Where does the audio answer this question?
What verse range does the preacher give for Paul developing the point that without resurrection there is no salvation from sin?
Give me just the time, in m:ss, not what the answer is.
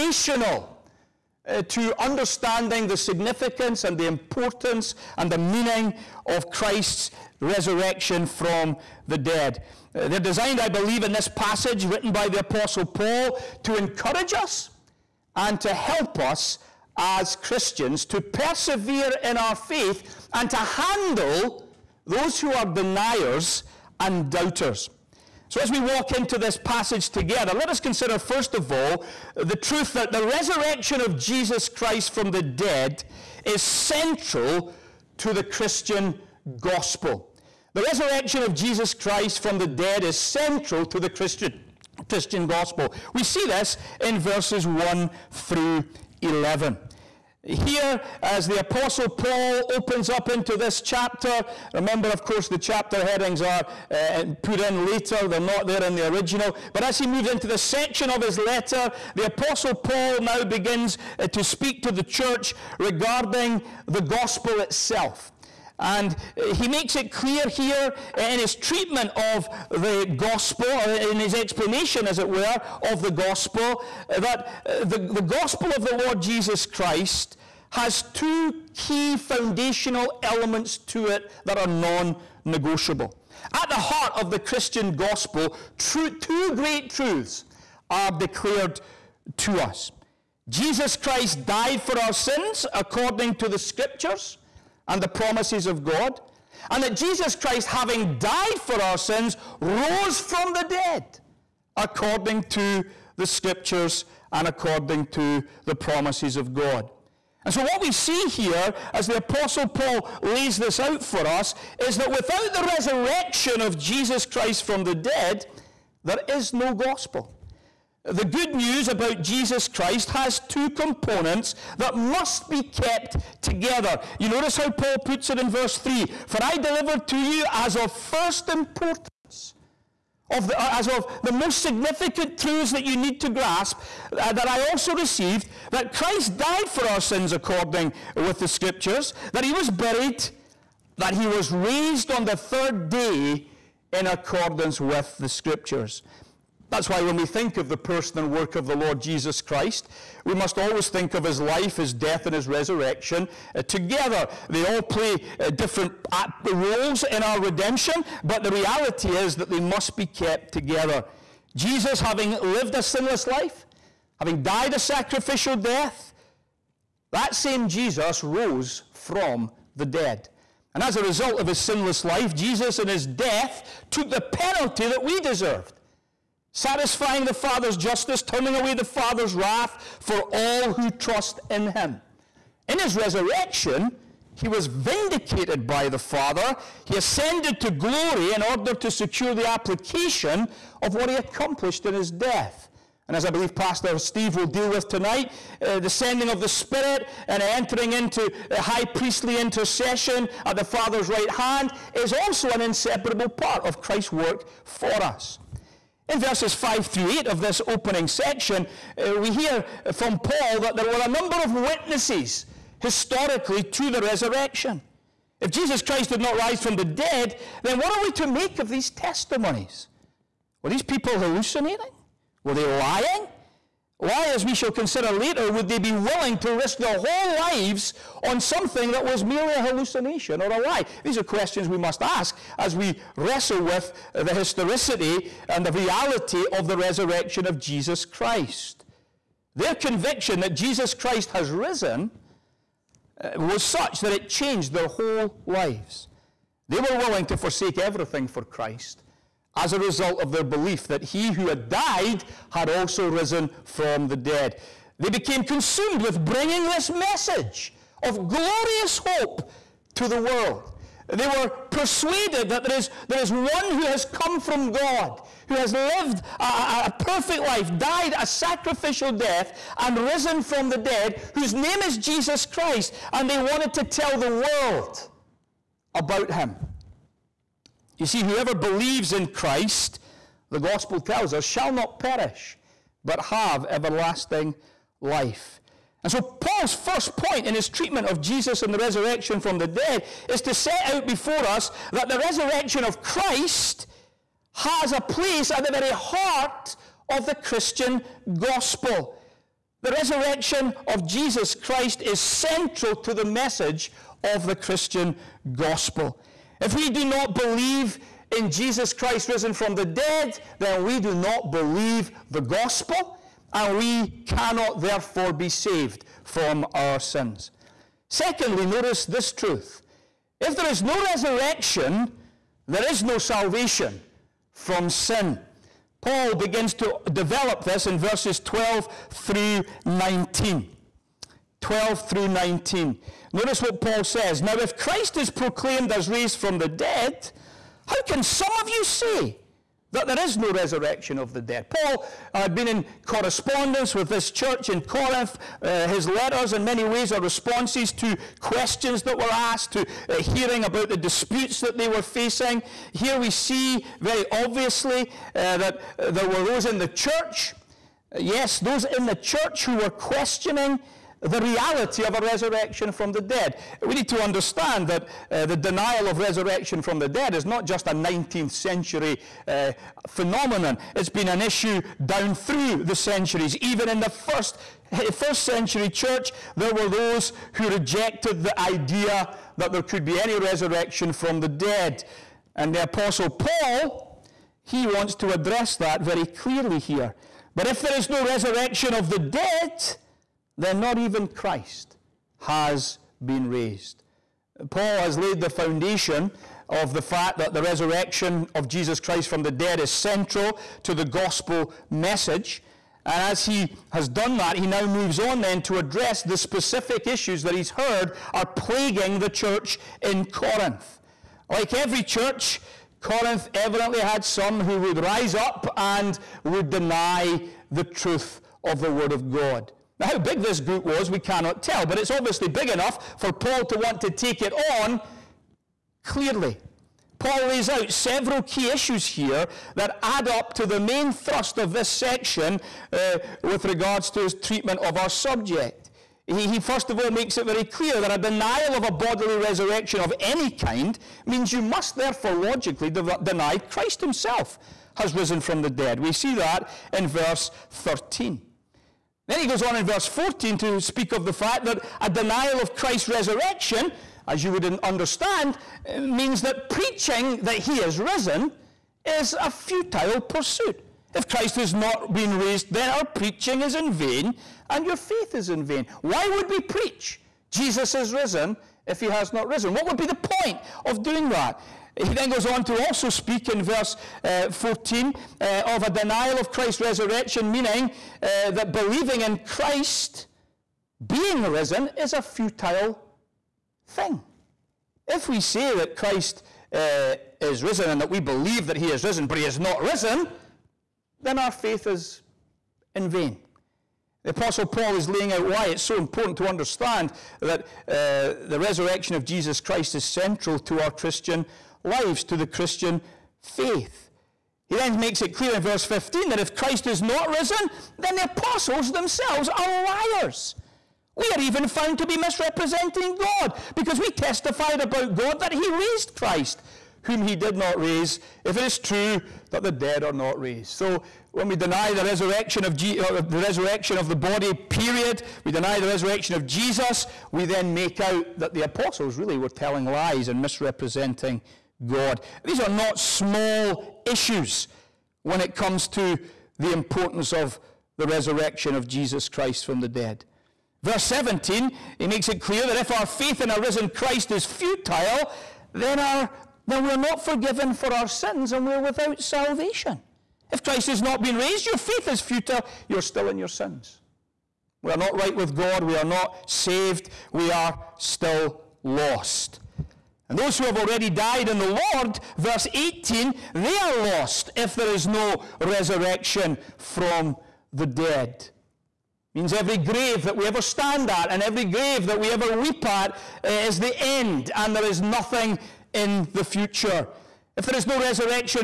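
5:27.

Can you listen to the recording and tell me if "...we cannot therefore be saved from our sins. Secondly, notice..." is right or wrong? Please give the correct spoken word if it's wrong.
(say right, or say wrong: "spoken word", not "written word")
right.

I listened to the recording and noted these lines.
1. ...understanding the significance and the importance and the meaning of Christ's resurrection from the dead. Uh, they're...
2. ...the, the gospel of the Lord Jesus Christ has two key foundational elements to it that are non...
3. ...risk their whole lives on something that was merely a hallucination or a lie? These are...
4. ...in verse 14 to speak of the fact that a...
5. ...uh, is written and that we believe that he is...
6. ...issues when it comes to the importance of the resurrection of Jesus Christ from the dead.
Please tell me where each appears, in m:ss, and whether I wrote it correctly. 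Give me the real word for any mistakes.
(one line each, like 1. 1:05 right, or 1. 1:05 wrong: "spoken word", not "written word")
1. 0:01 right
2. 1:14 right
3. 3:46 right
4. 7:29 right
5. 8:06 wrong: "risen", not "written"
6. 8:54 right.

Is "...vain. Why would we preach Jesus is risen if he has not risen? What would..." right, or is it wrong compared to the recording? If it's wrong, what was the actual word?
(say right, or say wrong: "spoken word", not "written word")
right.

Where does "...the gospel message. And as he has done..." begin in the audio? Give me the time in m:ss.
6:40.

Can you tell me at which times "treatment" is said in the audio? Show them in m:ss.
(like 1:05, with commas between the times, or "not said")
1:08, 4:47, 7:14.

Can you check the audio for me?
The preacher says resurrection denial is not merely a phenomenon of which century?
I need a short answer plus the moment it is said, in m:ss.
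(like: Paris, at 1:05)
19th century, at 6:07.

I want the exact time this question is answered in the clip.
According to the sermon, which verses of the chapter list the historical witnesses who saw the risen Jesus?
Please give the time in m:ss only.
3:26.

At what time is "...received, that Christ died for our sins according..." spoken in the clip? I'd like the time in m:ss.
2:14.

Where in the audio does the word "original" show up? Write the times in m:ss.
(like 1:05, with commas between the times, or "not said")
0:56.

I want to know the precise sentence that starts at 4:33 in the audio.
And they wanted to tell the world about him.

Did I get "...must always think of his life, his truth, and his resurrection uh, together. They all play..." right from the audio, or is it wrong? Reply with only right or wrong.
wrong.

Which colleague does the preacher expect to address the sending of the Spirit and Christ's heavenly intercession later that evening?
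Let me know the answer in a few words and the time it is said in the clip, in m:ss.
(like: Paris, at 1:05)
Pastor Steve, at 3:13.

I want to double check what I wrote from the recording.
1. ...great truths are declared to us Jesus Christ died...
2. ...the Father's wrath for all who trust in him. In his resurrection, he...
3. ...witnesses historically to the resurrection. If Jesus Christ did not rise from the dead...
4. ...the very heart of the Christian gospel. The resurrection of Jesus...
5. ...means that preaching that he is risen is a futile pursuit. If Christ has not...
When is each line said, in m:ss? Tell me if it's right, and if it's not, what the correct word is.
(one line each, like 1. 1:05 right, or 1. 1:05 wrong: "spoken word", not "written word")
1. 1:26 right
2. 2:58 right
3. 3:31 right
4. 4:55 right
5. 7:36 right.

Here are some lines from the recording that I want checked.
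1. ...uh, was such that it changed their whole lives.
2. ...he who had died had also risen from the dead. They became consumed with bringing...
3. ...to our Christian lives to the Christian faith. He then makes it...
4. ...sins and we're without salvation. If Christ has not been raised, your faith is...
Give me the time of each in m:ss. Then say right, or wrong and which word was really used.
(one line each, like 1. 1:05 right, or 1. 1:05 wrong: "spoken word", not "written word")
1. 4:03 right
2. 4:11 right
3. 8:20 right
4. 9:08 right.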